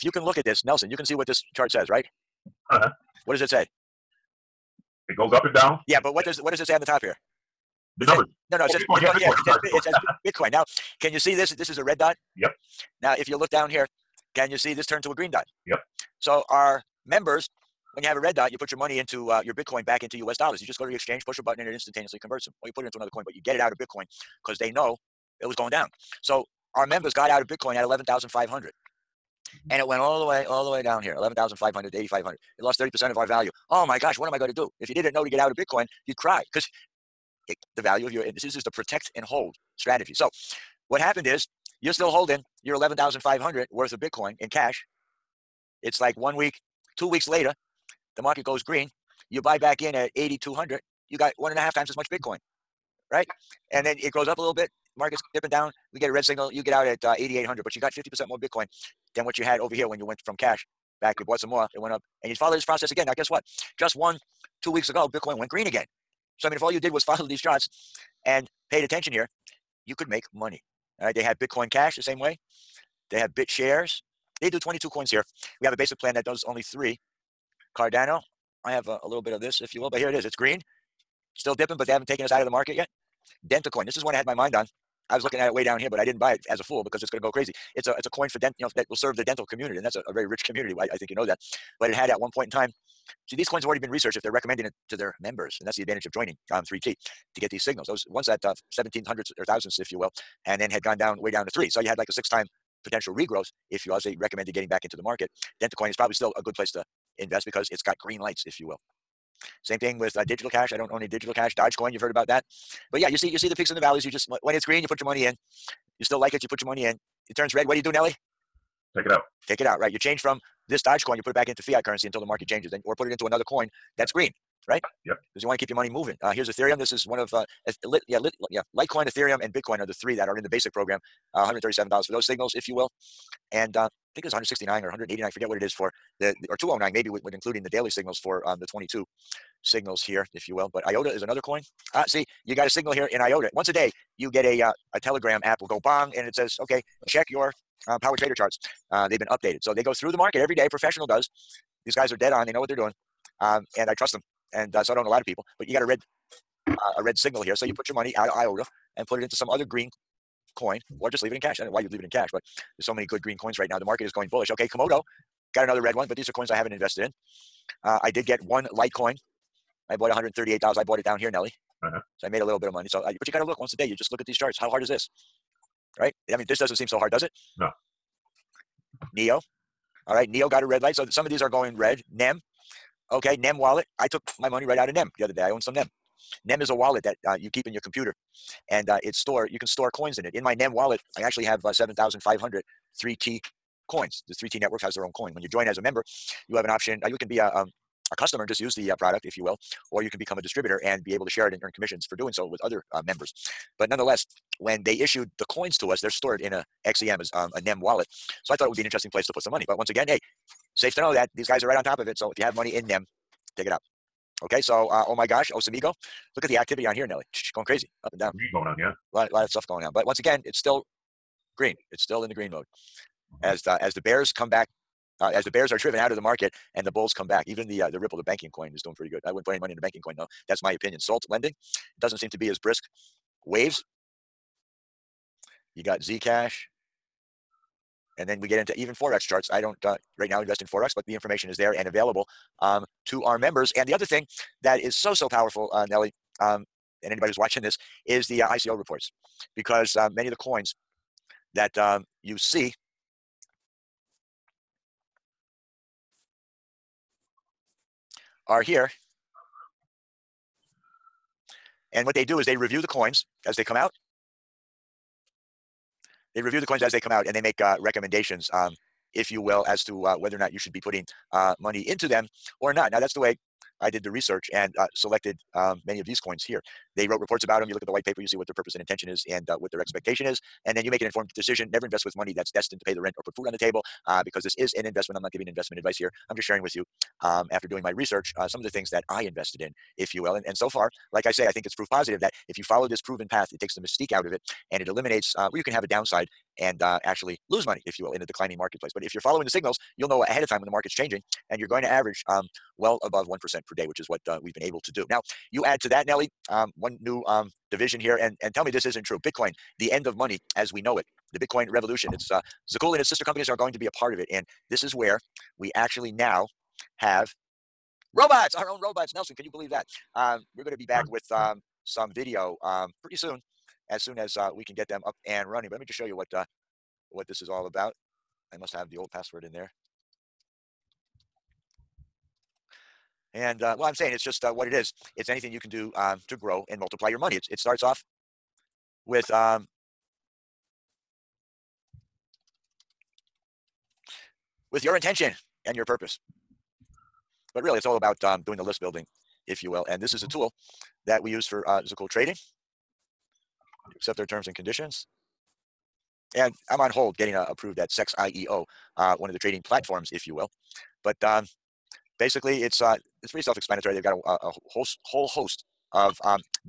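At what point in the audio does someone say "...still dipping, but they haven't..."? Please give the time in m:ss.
1:21.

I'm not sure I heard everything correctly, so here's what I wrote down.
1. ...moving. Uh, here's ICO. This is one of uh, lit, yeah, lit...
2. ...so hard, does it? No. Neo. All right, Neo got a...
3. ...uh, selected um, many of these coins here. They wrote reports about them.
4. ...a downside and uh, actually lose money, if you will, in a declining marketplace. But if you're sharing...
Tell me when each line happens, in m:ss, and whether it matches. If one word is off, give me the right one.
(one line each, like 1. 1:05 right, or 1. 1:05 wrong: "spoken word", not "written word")
1. 2:05 wrong: "Ethereum", not "ICO"
2. 2:56 right
3. 4:34 right
4. 4:55 wrong: "following", not "sharing".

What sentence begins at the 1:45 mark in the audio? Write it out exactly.
Dentacoin is probably still a good place to invest because it's got green lights, if you will.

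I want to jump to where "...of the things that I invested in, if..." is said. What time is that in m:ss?
4:48.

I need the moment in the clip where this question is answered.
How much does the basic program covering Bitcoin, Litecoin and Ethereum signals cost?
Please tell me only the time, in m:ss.
2:11.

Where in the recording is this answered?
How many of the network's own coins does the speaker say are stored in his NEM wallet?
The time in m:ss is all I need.
3:11.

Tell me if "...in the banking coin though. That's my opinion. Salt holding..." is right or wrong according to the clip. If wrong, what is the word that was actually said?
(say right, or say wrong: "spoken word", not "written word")
wrong: "lending", not "holding".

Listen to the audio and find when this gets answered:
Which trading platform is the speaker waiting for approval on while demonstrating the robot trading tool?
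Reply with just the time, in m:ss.
5:57.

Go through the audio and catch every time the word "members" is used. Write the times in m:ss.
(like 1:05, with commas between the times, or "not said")
0:17, 0:26, 1:35, 3:15, 3:23, 4:03.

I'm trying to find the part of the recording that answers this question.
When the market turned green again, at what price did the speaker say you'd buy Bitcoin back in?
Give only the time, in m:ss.
0:50.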